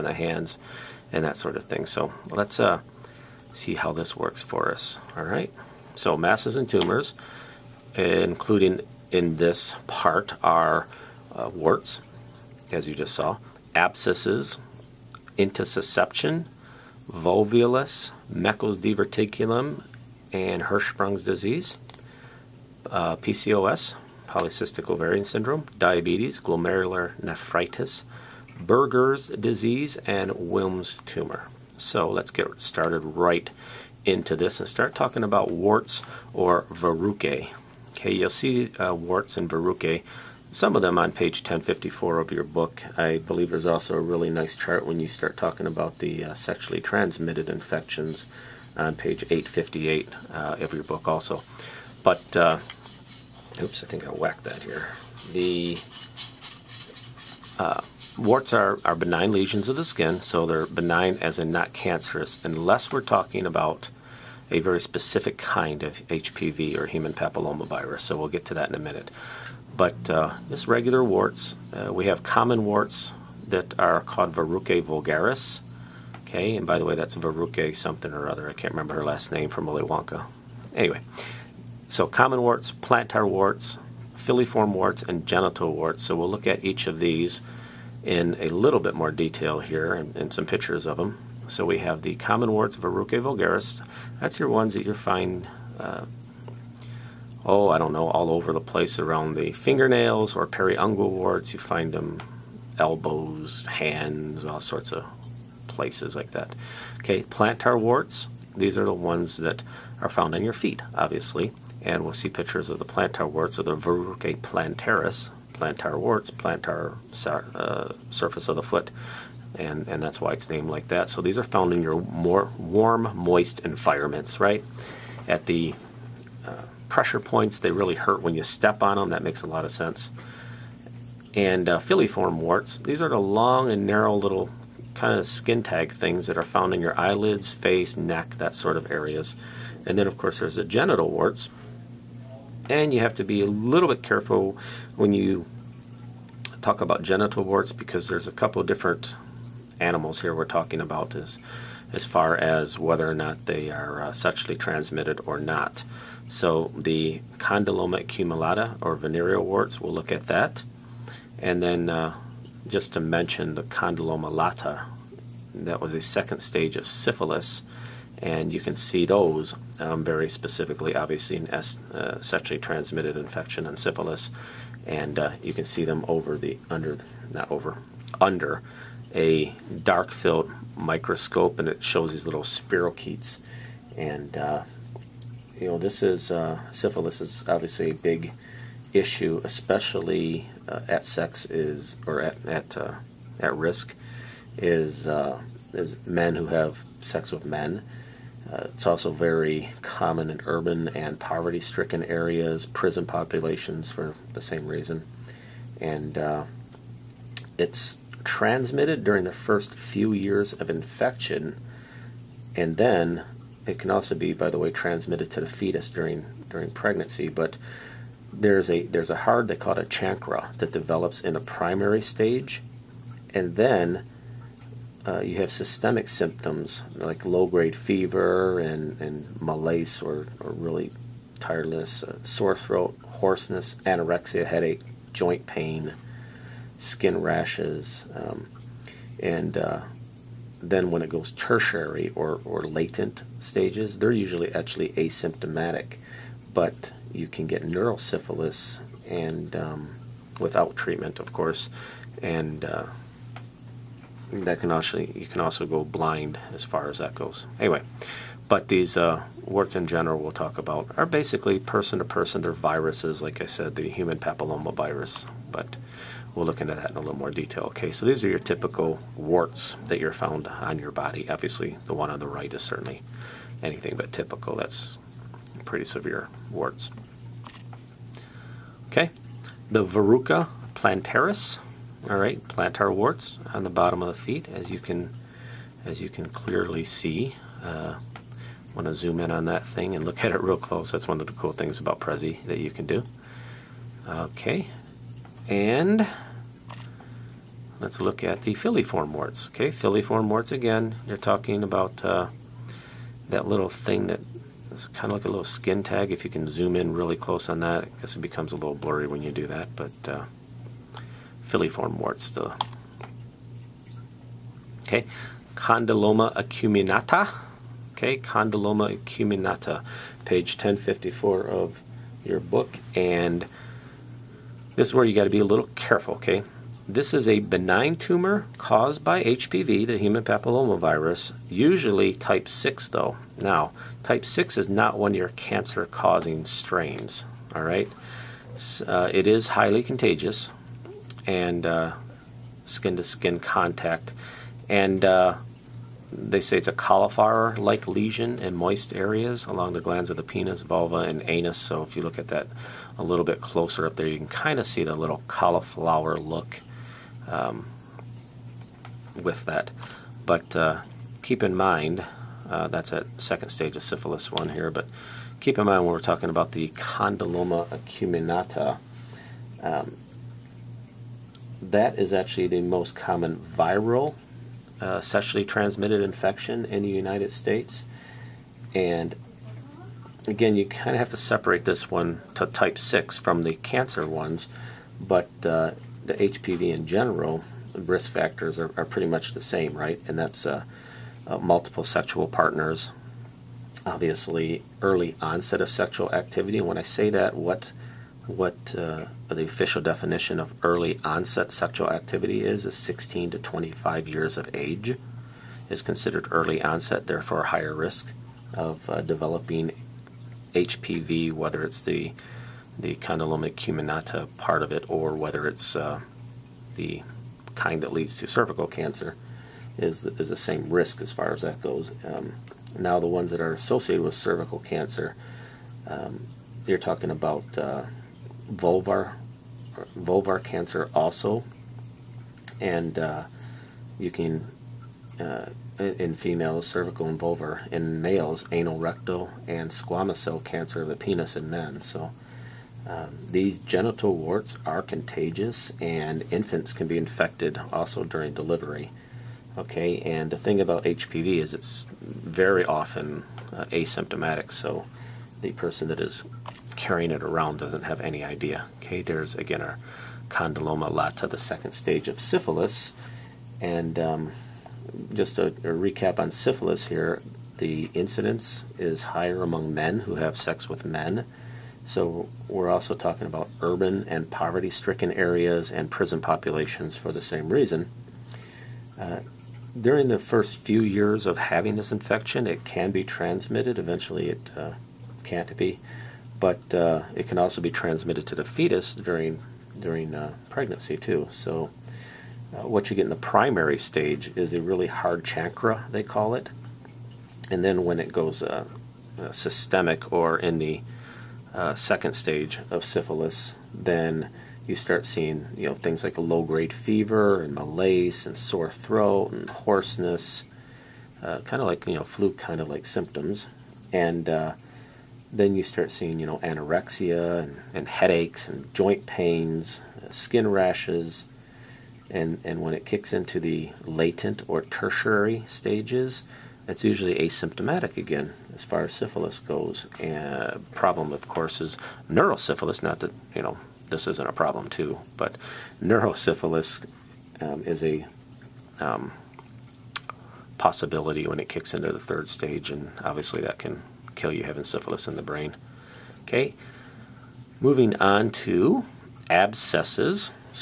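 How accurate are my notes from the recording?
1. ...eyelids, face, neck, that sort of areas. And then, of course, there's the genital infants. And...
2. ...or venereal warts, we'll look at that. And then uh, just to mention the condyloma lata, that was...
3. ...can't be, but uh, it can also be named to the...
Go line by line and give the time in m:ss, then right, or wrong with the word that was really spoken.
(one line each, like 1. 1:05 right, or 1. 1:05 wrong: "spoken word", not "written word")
1. 2:17 wrong: "warts", not "infants"
2. 2:38 right
3. 8:05 wrong: "transmitted", not "named".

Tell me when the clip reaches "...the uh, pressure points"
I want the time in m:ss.
2:05.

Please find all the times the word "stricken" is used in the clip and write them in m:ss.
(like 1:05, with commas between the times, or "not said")
3:21, 7:54.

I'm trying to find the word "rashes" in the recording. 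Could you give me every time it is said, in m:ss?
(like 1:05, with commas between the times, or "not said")
3:57, 8:40.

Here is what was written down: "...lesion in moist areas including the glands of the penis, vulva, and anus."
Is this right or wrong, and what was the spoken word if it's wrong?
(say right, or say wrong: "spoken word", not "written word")
wrong: "along", not "including".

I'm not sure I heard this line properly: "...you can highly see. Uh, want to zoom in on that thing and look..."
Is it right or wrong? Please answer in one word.
wrong.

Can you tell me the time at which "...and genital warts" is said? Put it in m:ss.
1:25.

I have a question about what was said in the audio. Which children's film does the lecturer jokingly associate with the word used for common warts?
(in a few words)
Willy Wonka.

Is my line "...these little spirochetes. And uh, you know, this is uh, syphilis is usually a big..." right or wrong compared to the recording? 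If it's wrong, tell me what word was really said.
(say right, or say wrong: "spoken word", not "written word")
wrong: "obviously", not "usually".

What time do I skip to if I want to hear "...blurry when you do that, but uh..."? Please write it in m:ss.
5:08.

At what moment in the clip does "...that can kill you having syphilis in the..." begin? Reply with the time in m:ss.
9:03.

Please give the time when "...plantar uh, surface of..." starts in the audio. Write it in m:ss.
1:56.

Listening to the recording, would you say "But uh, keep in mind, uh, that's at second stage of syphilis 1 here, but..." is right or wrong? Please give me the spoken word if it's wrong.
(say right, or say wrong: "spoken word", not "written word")
right.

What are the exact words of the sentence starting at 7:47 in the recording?
The incidence is higher among men who have sex with men.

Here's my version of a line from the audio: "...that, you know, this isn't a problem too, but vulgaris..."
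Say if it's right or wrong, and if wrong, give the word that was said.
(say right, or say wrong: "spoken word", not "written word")
wrong: "neurosyphilis", not "vulgaris".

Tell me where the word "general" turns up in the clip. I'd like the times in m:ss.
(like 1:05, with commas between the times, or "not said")
4:19, 6:26.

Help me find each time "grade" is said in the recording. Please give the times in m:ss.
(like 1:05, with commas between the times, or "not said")
3:47, 8:26.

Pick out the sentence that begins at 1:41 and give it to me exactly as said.
You find them elbows, hands, all sorts of places like that.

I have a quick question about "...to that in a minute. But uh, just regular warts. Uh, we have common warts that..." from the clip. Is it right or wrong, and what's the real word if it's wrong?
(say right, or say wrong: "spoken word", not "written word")
right.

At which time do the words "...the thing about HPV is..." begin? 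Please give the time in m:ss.
7:30.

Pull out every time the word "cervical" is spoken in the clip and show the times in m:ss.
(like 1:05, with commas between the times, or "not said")
6:58, 7:04, 7:16.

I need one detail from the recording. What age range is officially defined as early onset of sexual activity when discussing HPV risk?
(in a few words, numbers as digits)
16 to 25.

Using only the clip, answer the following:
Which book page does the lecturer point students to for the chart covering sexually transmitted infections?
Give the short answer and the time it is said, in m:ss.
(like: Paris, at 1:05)
858, at 0:48.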